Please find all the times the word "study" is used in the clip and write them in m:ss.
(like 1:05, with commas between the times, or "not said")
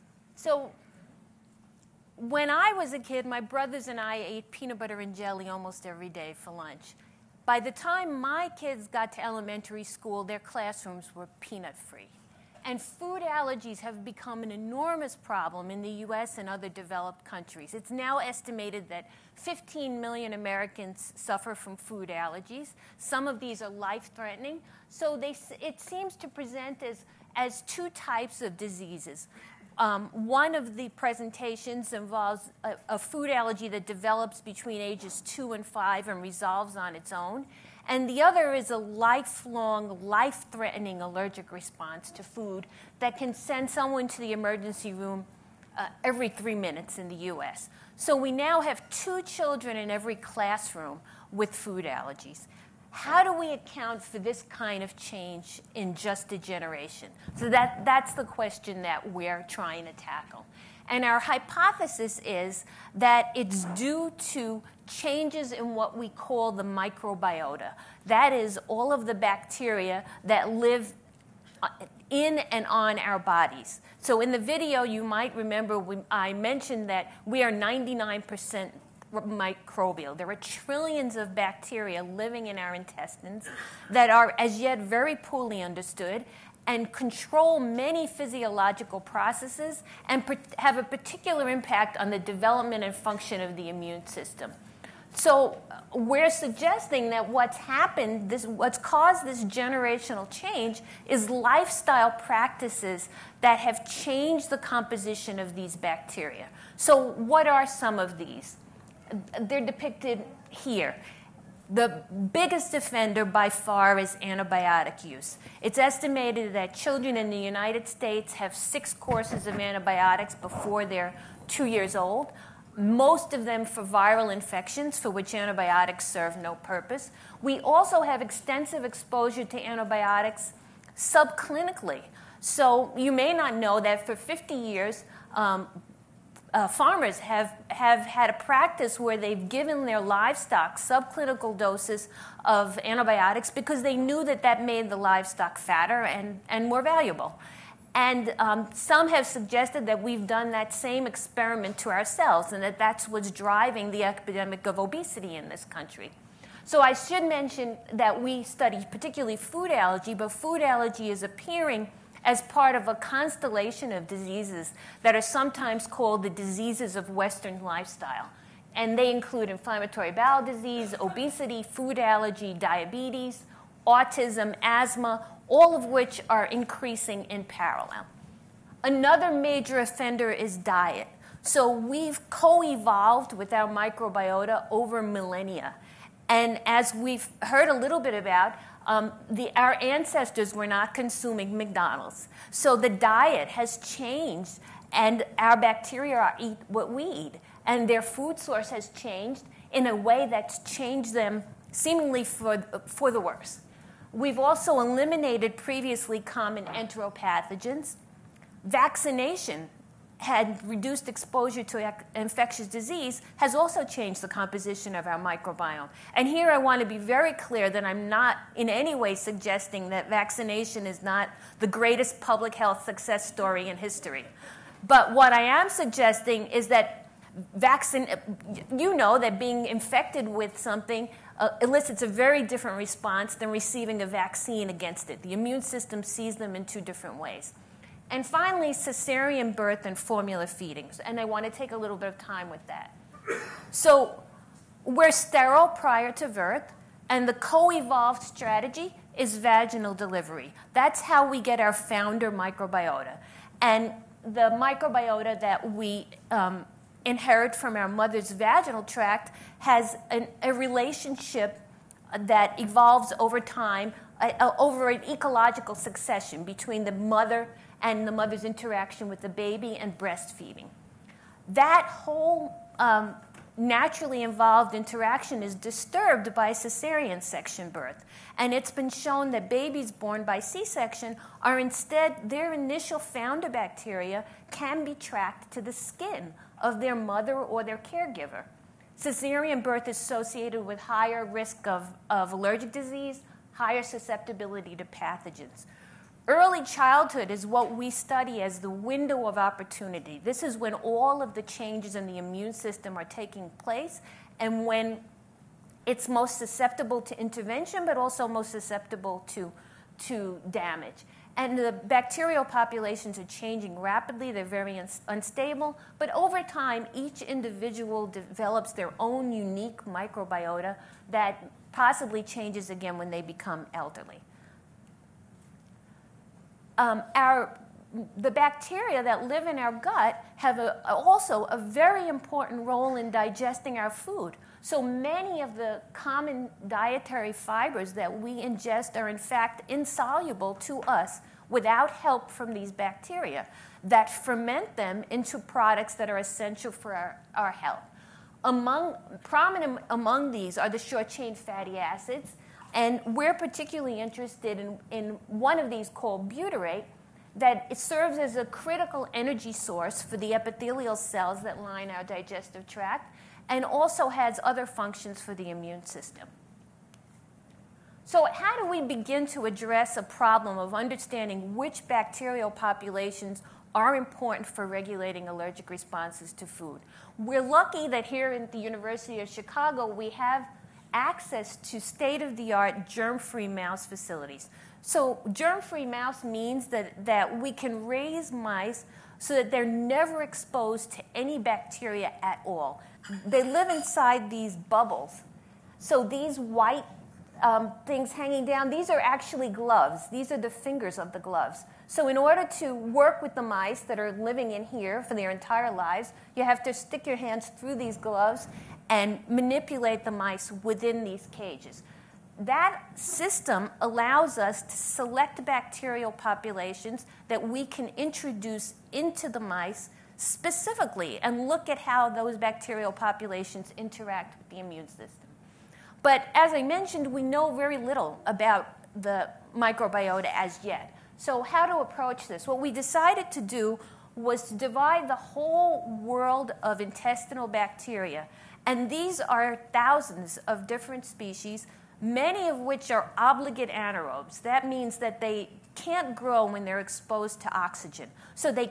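2:38, 4:57.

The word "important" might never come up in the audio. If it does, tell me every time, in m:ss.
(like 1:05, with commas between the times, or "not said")
5:32, 6:13.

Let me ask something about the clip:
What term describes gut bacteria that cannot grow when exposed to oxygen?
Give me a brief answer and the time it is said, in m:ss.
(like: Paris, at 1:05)
obligate anaerobes, at 7:23.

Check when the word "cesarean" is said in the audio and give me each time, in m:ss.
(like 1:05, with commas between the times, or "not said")
3:58, 4:36, 4:48.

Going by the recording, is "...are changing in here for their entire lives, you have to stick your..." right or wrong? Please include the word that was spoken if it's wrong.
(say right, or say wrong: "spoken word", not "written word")
wrong: "living", not "changing".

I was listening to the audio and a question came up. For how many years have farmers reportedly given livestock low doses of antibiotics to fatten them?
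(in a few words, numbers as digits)
50.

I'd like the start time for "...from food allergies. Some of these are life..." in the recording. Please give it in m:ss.
0:21.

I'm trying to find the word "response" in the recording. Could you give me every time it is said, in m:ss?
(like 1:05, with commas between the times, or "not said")
0:41, 3:52, 6:15.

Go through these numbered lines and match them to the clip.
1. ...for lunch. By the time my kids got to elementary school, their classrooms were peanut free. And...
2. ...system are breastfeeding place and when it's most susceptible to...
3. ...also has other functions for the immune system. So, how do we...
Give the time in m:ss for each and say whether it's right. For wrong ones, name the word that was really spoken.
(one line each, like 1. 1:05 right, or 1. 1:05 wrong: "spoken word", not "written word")
1. 0:06 right
2. 5:02 wrong: "taking", not "breastfeeding"
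3. 6:03 right.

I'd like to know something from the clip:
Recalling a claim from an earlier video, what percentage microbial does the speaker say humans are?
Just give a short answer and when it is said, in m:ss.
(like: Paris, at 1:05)
99%, at 1:17.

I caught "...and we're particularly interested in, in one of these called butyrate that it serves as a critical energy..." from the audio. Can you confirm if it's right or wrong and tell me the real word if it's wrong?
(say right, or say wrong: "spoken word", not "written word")
right.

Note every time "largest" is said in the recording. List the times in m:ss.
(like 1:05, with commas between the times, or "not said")
not said.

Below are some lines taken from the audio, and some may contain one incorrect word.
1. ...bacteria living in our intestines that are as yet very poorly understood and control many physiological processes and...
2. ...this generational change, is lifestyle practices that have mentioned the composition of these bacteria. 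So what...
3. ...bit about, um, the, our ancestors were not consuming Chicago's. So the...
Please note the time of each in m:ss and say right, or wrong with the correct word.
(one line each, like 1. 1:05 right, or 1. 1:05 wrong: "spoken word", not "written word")
1. 1:21 right
2. 1:39 wrong: "changed", not "mentioned"
3. 3:07 wrong: "McDonald", not "Chicago".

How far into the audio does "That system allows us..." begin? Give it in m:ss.
6:52.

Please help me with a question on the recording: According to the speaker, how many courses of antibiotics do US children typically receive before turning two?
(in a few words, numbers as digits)
6.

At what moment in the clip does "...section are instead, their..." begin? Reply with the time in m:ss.
4:40.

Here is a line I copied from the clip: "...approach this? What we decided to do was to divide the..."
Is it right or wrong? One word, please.
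right.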